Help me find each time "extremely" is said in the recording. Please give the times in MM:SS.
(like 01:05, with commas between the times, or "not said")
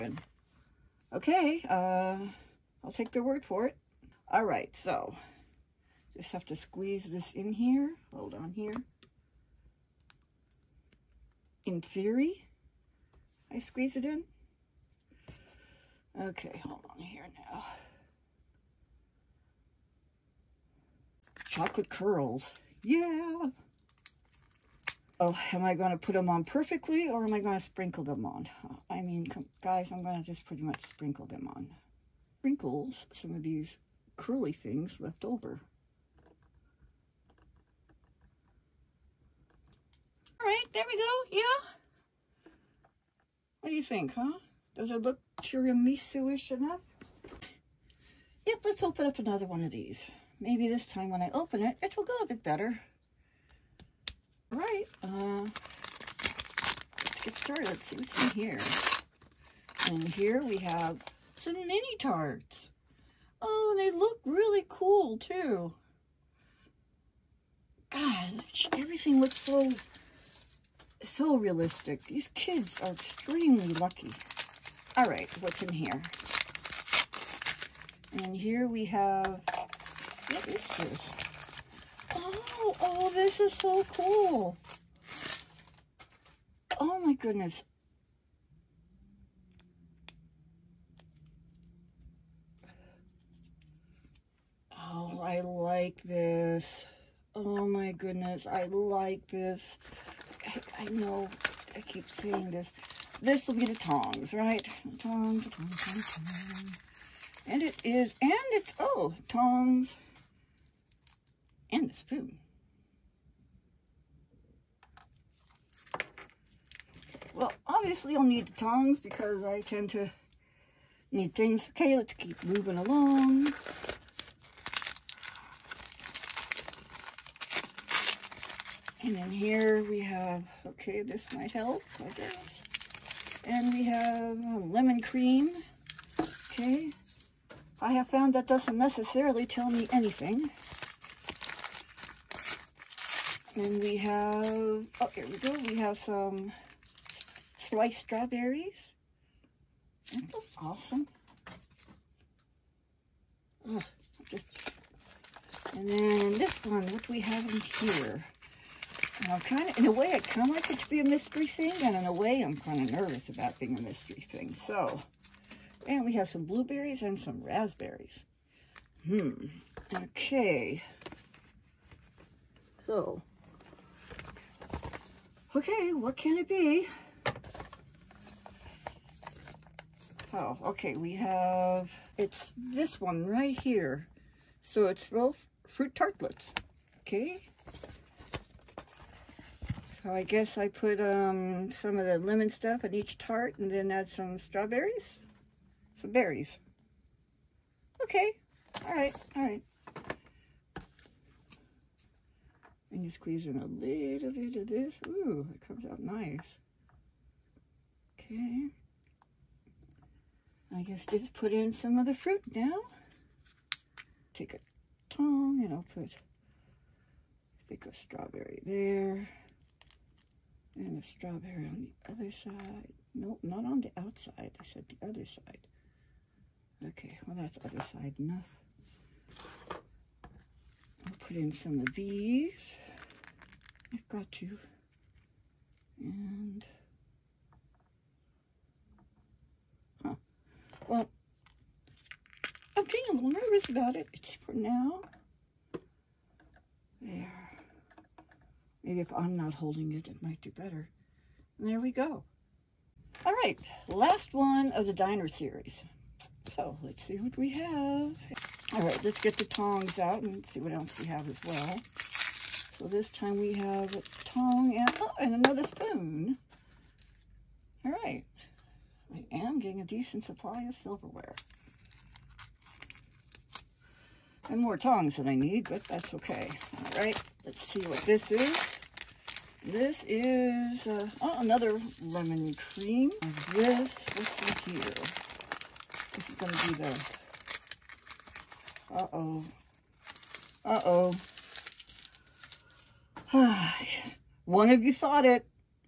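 01:12.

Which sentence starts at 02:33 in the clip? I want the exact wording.
Ugh, just, and then this one, what do we have in here?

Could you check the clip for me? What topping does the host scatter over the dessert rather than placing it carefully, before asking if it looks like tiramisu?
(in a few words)
Chocolate curls.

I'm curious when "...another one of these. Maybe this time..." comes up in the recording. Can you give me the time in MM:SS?
00:49.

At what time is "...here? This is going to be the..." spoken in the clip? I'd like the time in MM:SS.
04:44.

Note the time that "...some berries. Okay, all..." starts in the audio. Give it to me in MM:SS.
03:15.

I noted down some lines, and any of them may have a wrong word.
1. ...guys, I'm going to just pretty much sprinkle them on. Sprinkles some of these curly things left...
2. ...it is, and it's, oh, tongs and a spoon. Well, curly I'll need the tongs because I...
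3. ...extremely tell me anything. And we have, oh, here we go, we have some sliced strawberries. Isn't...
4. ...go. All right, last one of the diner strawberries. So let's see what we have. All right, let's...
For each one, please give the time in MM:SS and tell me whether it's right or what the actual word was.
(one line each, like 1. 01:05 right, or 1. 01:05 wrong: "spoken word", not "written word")
1. 00:29 right
2. 01:47 wrong: "obviously", not "curly"
3. 02:18 wrong: "necessarily", not "extremely"
4. 04:11 wrong: "series", not "strawberries".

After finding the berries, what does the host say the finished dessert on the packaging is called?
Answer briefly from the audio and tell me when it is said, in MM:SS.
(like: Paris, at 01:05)
Real fruit tartlets, at 03:05.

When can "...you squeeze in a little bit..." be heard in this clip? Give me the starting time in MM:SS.
03:23.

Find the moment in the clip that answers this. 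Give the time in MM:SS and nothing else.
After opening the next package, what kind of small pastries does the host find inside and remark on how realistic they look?
01:01.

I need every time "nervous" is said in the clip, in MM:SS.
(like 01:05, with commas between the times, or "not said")
02:42, 04:03.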